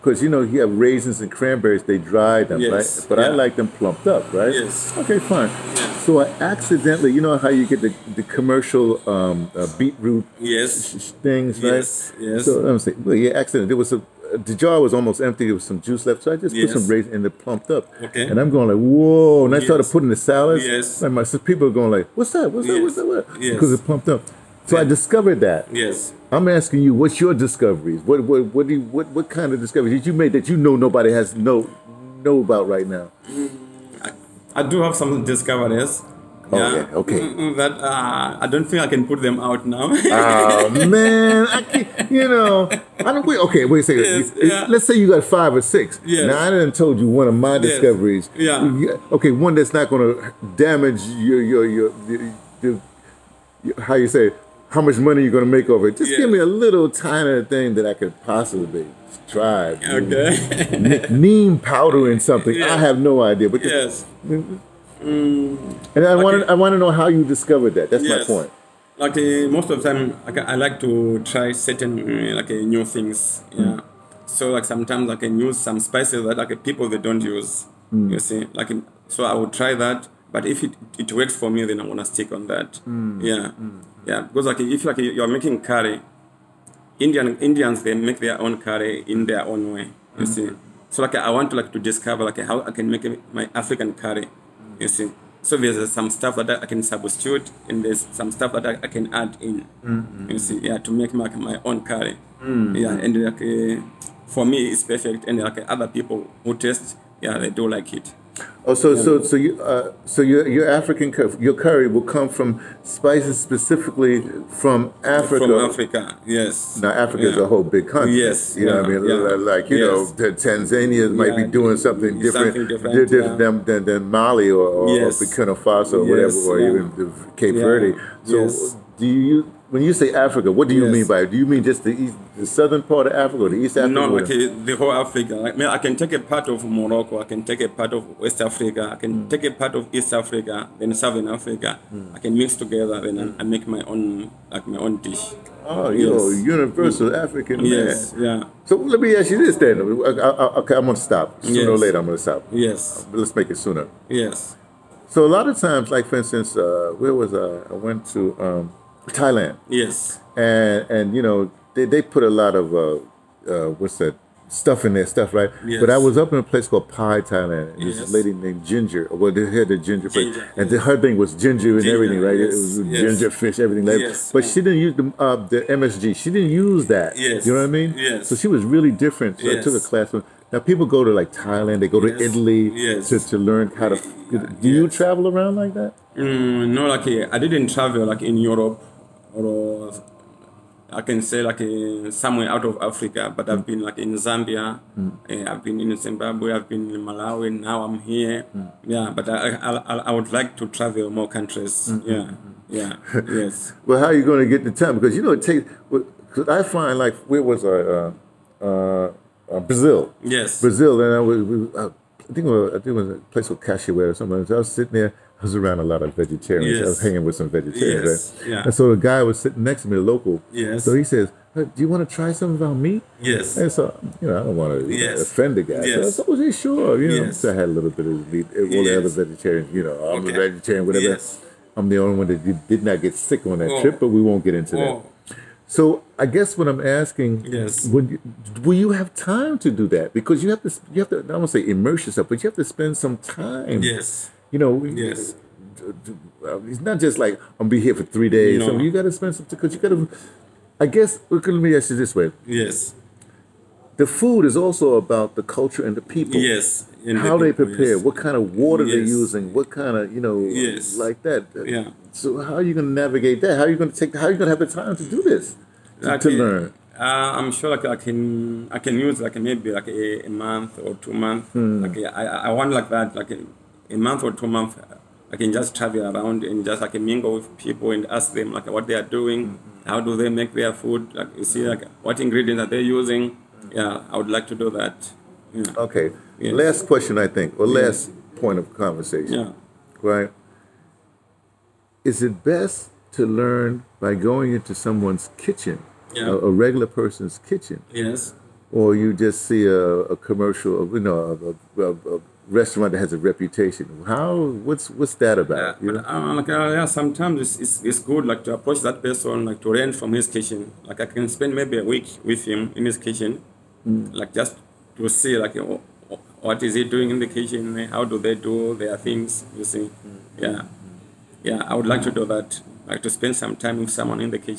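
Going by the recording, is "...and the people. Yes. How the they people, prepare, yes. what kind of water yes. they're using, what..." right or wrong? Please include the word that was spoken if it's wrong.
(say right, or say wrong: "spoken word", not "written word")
right.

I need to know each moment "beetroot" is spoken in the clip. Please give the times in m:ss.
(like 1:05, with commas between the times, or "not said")
0:09.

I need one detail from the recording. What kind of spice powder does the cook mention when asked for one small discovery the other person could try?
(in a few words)
Neem powder.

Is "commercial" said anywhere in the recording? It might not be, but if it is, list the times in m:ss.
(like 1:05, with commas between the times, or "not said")
0:08, 5:00.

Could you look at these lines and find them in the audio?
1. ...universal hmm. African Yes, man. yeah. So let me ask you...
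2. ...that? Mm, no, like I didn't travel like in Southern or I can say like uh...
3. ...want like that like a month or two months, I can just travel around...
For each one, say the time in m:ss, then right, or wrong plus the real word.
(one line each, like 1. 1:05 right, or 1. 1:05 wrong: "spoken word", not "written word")
1. 2:26 right
2. 3:05 wrong: "Europe", not "Southern"
3. 4:32 right.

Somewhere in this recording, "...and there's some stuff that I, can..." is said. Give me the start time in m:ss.
1:37.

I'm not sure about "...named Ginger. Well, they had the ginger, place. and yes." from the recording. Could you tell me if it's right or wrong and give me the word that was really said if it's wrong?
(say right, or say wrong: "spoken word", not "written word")
right.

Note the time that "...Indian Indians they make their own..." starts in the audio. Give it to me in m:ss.
1:26.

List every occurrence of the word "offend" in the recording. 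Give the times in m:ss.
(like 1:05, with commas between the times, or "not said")
3:45.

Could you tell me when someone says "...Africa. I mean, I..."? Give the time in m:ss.
2:14.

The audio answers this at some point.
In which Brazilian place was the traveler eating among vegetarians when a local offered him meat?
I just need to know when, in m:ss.
3:33.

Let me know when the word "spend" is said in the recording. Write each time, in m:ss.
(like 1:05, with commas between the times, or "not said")
4:02, 4:09, 5:11, 5:23.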